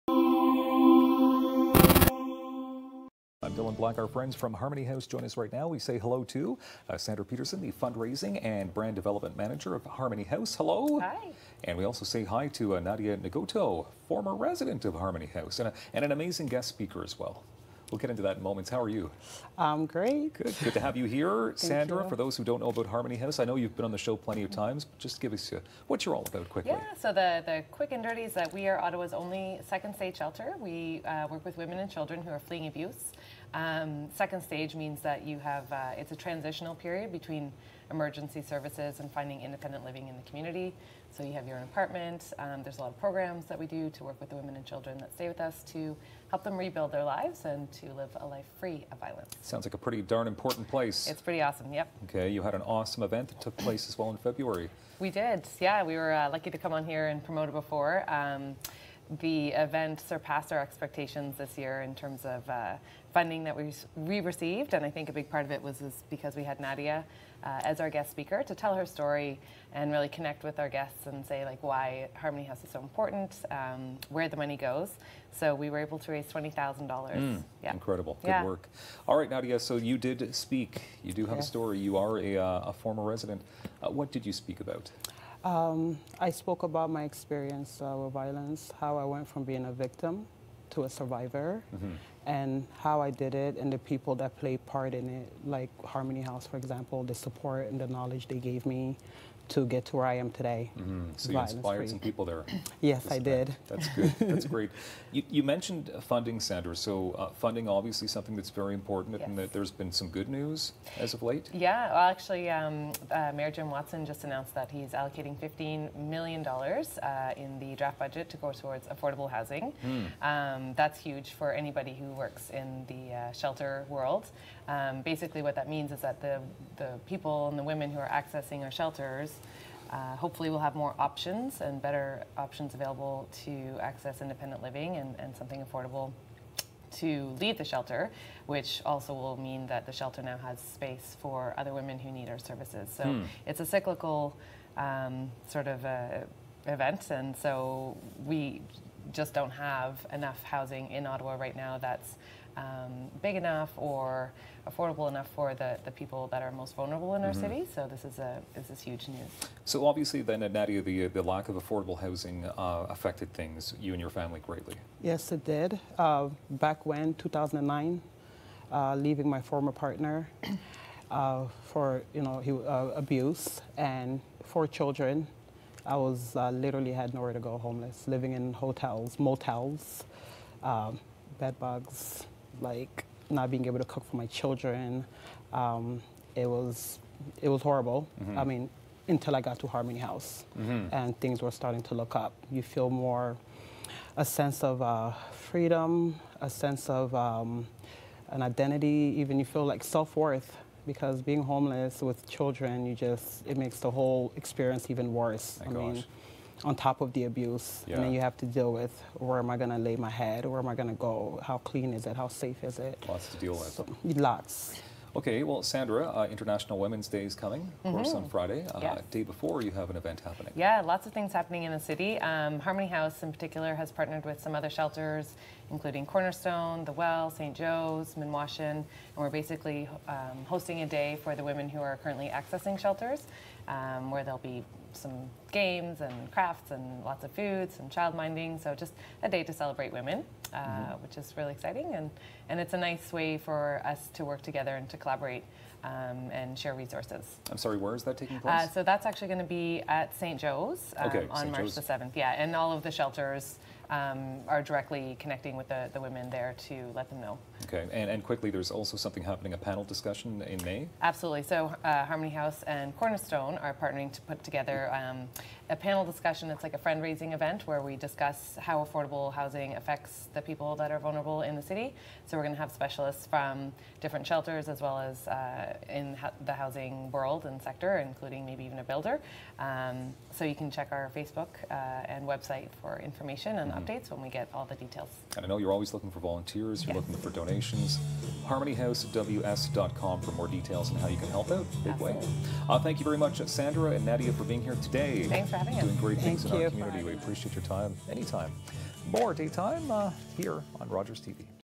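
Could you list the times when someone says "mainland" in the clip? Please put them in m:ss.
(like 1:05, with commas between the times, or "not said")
not said.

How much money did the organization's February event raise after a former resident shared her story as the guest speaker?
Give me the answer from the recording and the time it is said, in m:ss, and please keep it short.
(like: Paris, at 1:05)
$20,000, at 1:16.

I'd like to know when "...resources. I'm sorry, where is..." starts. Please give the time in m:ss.
4:06.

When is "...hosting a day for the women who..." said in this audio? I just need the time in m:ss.
3:50.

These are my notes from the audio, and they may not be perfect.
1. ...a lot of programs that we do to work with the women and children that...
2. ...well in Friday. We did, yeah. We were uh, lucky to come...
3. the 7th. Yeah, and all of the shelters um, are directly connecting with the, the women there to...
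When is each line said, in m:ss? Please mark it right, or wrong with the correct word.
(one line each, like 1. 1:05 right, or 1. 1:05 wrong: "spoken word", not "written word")
1. 0:42 right
2. 0:53 wrong: "February", not "Friday"
3. 4:11 right.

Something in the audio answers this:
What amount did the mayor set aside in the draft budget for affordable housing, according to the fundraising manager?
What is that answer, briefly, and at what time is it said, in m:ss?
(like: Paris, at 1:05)
15 million dollars, at 1:55.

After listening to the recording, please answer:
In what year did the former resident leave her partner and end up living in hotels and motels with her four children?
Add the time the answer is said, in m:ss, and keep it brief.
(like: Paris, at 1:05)
2009, at 2:47.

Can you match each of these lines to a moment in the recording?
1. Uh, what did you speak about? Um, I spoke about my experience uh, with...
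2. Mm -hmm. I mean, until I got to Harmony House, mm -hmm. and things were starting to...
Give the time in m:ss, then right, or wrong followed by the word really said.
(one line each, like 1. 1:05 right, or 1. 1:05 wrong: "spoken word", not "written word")
1. 1:23 right
2. 3:08 right.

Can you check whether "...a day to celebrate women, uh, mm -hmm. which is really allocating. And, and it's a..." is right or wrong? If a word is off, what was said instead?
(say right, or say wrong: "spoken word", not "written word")
wrong: "exciting", not "allocating".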